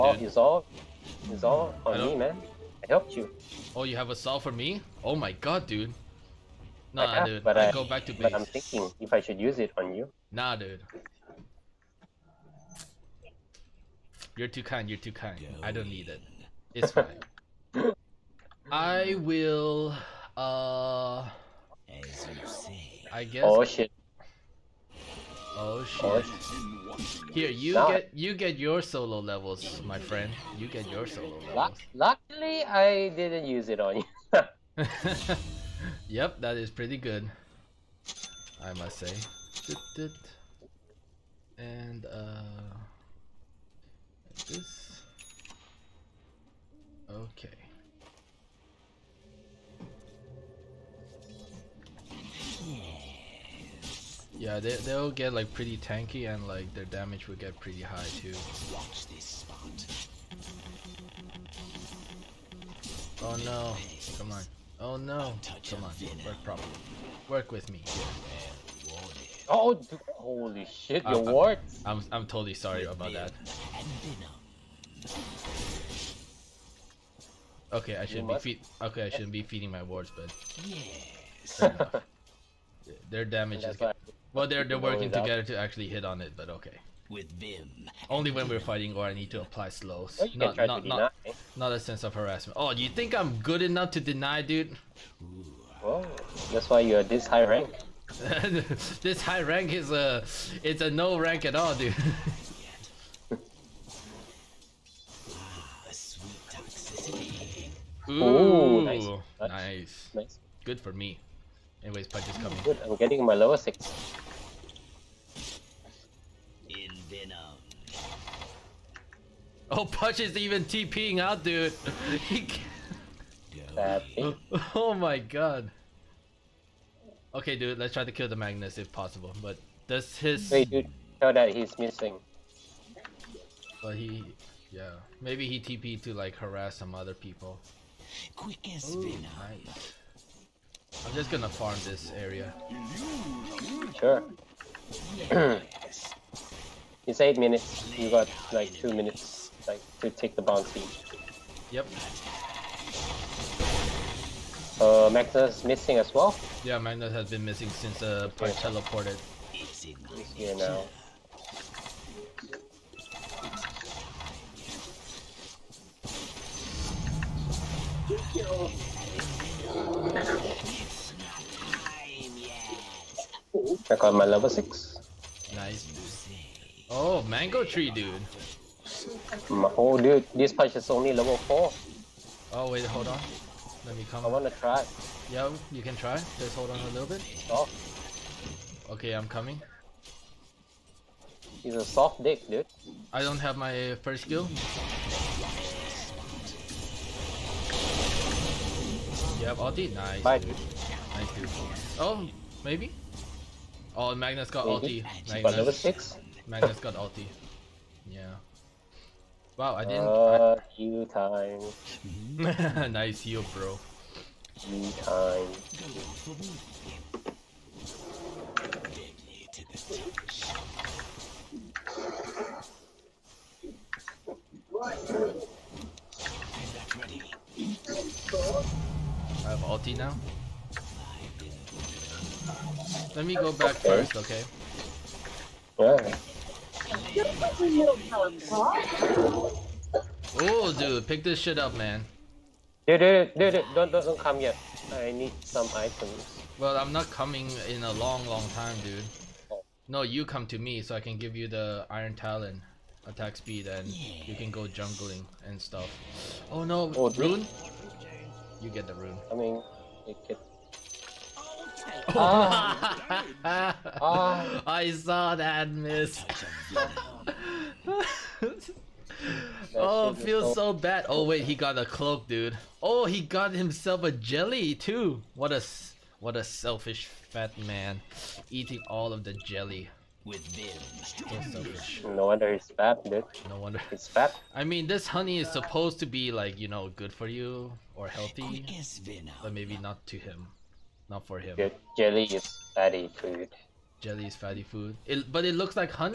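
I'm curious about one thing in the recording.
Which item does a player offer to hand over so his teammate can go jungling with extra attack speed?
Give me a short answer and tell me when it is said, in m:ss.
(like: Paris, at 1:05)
Iron Talon, at 4:11.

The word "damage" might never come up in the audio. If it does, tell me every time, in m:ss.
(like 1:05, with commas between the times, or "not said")
0:56, 1:23.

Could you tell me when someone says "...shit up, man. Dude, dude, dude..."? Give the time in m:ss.
4:01.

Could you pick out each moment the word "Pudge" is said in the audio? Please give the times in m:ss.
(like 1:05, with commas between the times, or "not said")
1:52.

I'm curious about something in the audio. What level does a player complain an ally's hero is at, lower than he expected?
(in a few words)
4.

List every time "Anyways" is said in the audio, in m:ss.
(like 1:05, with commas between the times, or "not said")
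1:51.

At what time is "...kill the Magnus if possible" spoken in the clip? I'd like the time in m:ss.
2:08.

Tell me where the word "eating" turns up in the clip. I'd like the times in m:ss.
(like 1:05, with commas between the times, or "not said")
4:38.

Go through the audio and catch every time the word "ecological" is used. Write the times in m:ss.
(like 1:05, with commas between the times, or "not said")
not said.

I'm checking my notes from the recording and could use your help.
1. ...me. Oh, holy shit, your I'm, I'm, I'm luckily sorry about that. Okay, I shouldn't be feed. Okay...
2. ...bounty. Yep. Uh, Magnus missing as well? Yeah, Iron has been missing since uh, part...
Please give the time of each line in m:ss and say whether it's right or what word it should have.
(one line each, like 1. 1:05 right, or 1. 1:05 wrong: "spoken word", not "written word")
1. 1:07 wrong: "totally", not "luckily"
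2. 2:30 wrong: "Magnus", not "Iron".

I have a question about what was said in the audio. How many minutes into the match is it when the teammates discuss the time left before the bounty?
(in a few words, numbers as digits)
8.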